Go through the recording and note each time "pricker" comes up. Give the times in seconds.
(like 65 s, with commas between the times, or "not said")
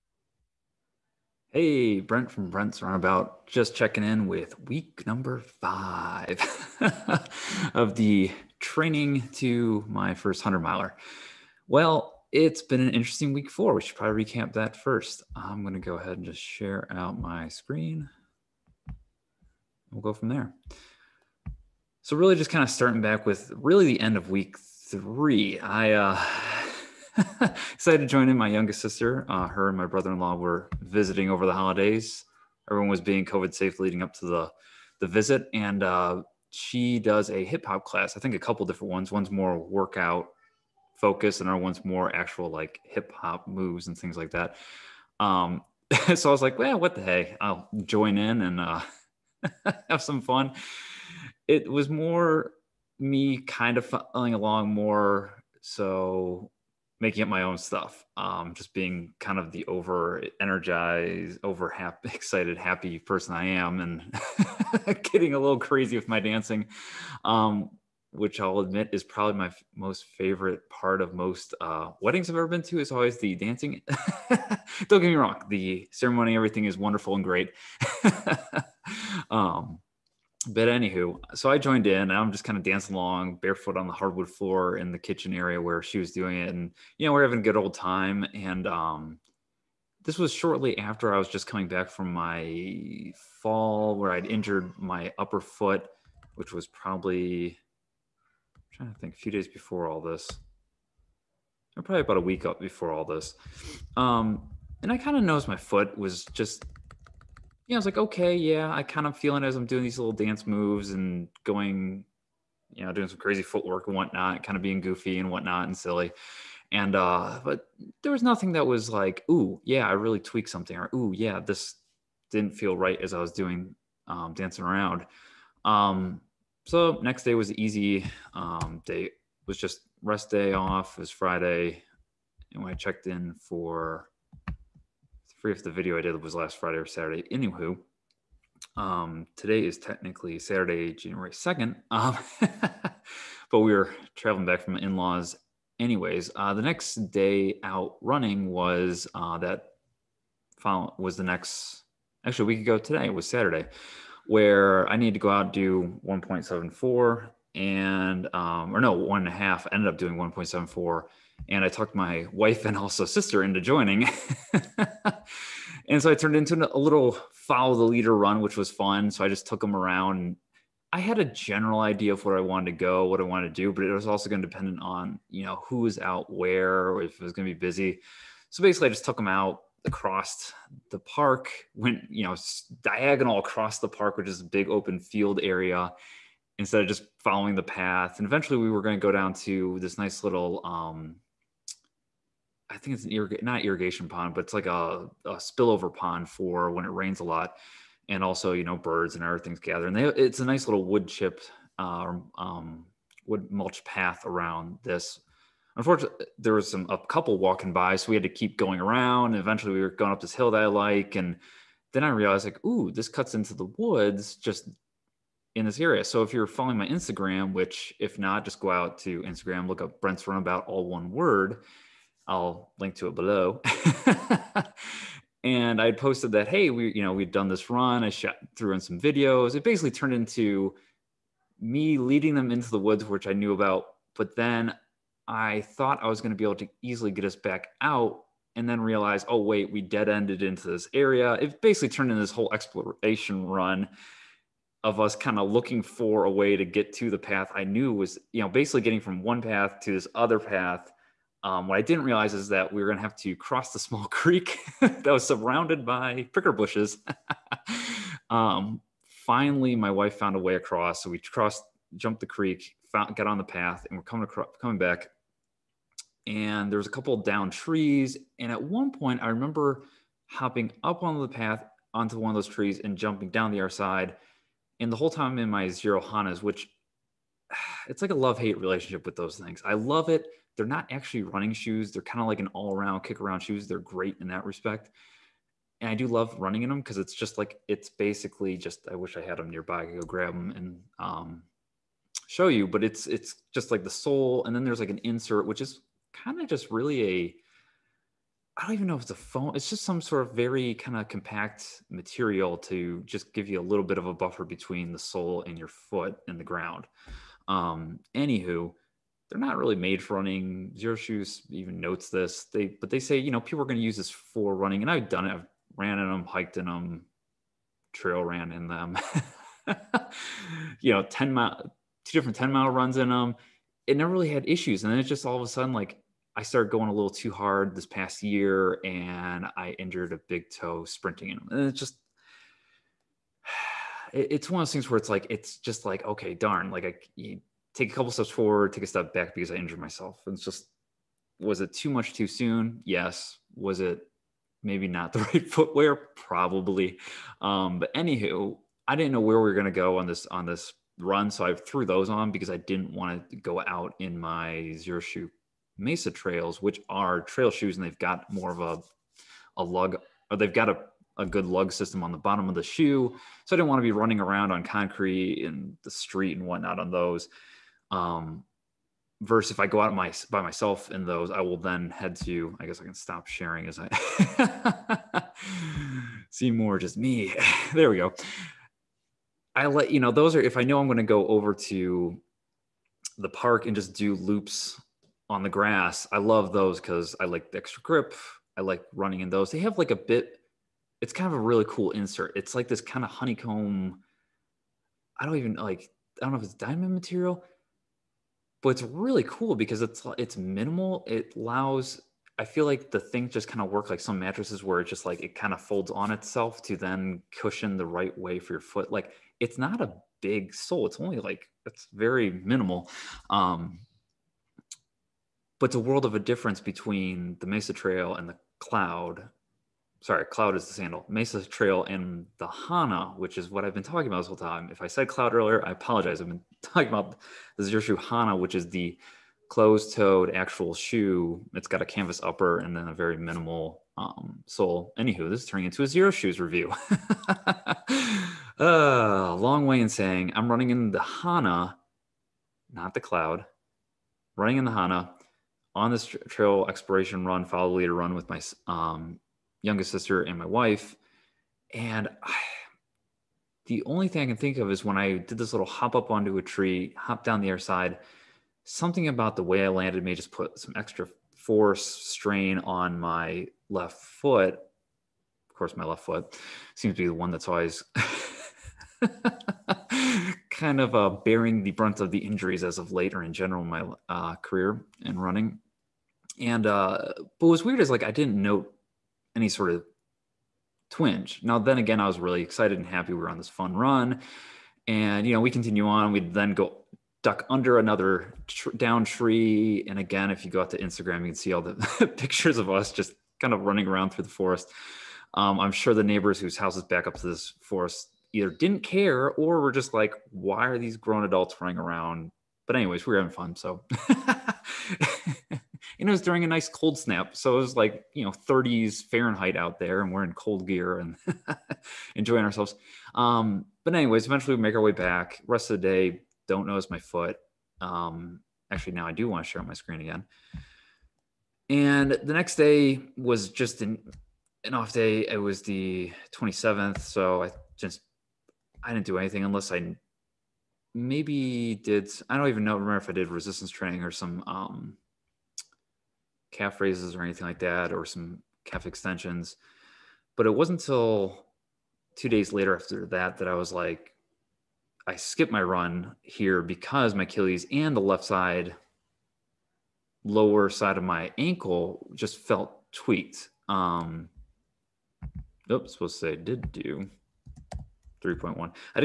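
256 s.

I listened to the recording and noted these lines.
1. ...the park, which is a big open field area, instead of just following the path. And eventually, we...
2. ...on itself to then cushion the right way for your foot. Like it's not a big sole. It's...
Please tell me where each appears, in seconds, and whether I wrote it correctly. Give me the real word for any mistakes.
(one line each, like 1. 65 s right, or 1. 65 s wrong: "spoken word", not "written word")
1. 183 s right
2. 405 s right.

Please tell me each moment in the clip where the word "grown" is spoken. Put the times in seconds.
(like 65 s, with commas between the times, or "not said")
500 s.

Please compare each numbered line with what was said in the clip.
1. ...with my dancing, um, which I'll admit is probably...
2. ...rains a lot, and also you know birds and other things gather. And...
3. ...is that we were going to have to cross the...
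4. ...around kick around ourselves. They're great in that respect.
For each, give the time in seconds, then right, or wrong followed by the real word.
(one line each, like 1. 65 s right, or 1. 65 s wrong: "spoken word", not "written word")
1. 65 s right
2. 196 s right
3. 252 s right
4. 282 s wrong: "shoes", not "ourselves".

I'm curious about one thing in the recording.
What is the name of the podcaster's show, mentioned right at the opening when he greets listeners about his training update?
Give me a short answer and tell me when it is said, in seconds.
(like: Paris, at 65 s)
Brent's Run About, at 2 s.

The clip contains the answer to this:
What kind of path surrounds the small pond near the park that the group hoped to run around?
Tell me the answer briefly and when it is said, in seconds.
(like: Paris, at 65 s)
wood mulch path, at 203 s.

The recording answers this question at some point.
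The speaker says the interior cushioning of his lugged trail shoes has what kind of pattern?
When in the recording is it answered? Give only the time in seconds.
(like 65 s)
393 s.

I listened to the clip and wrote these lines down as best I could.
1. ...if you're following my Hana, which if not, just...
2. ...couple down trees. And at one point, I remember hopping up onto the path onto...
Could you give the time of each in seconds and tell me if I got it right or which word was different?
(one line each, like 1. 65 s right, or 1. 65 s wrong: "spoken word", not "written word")
1. 216 s wrong: "Instagram", not "Hana"
2. 266 s right.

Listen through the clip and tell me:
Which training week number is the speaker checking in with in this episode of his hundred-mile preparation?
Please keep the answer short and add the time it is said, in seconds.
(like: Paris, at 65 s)
5, at 5 s.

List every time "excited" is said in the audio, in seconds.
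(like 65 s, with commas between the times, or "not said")
27 s, 62 s, 482 s.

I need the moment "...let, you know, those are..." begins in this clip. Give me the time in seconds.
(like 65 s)
379 s.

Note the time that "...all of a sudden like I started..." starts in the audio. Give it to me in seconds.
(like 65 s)
325 s.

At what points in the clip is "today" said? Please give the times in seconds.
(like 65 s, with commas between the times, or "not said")
139 s, 152 s.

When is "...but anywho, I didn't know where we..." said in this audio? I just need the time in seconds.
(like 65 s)
347 s.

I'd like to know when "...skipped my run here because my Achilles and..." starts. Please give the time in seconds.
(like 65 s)
545 s.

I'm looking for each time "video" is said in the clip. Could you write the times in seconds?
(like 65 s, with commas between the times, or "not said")
135 s, 228 s.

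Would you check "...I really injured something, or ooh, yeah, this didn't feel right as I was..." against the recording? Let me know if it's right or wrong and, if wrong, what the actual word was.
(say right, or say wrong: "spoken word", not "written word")
wrong: "tweaked", not "injured".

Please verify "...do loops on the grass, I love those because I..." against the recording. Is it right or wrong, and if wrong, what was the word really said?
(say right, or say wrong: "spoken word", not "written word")
right.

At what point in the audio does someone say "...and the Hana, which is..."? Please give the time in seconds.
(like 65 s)
421 s.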